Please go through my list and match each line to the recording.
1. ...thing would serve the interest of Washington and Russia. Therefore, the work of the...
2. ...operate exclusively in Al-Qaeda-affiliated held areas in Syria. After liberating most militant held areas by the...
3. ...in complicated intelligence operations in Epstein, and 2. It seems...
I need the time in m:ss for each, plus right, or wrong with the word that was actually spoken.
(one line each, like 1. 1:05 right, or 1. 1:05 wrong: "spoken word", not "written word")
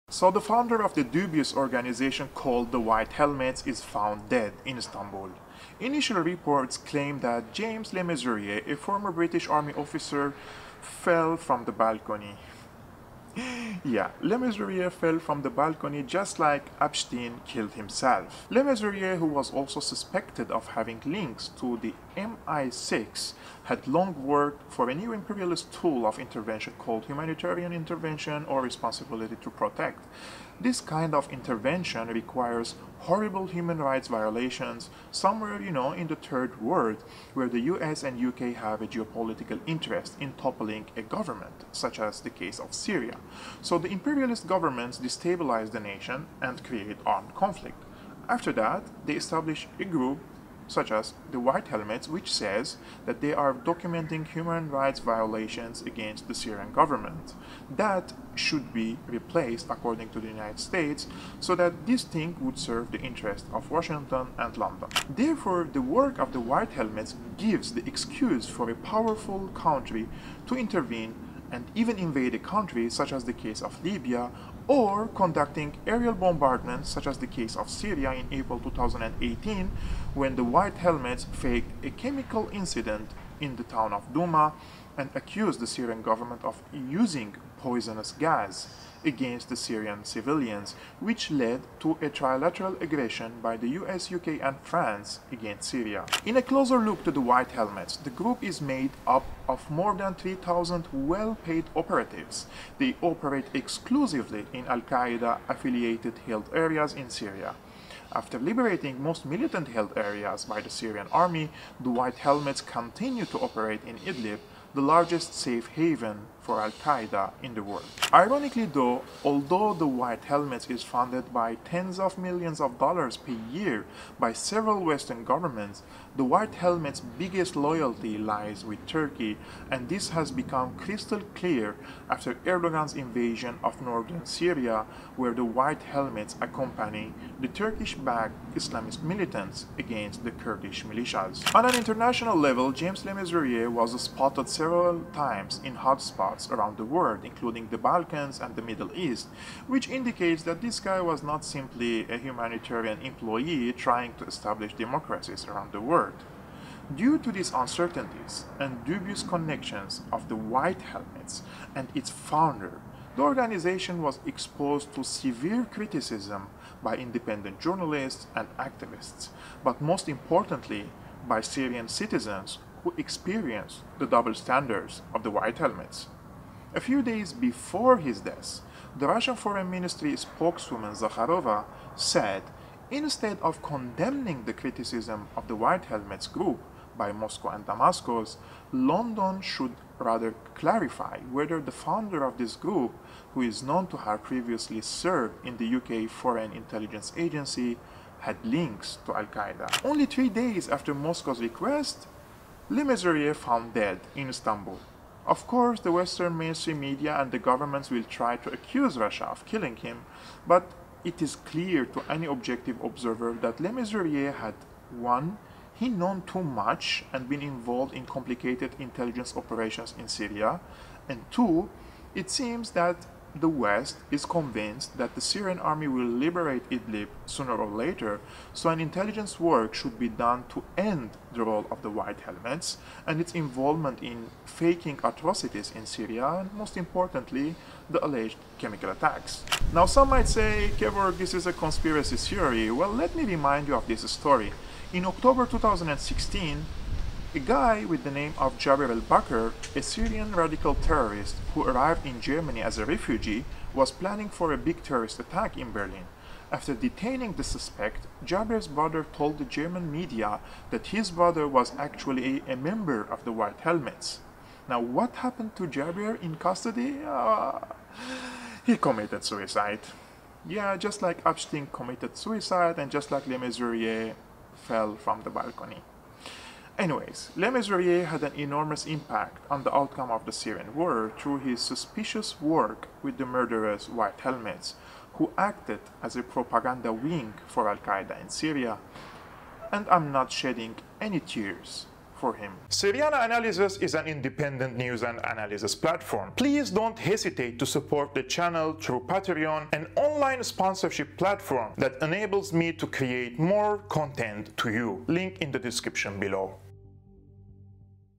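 1. 1:02 wrong: "London", not "Russia"
2. 1:43 right
3. 3:37 wrong: "Syria", not "Epstein".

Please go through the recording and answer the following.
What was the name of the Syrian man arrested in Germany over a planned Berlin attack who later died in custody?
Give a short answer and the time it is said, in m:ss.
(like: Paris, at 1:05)
Jabir al-Bakr, at 4:08.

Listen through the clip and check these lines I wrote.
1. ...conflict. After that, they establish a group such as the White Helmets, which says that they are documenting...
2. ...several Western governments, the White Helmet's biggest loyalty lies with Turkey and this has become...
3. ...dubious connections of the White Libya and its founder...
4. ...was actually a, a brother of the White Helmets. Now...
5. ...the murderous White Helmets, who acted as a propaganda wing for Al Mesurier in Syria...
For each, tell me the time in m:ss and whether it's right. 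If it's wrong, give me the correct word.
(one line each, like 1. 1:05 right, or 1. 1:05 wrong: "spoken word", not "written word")
1. 0:47 right
2. 2:04 right
3. 2:38 wrong: "Helmets", not "Libya"
4. 4:21 wrong: "member", not "brother"
5. 4:43 wrong: "Qaeda", not "Mesurier".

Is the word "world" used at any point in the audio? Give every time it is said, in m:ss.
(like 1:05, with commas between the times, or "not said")
0:36, 1:57, 2:26, 2:35.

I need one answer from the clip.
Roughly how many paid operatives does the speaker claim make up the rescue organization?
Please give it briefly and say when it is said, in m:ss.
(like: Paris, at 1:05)
More than 3,000, at 1:39.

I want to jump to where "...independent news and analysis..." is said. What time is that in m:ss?
4:54.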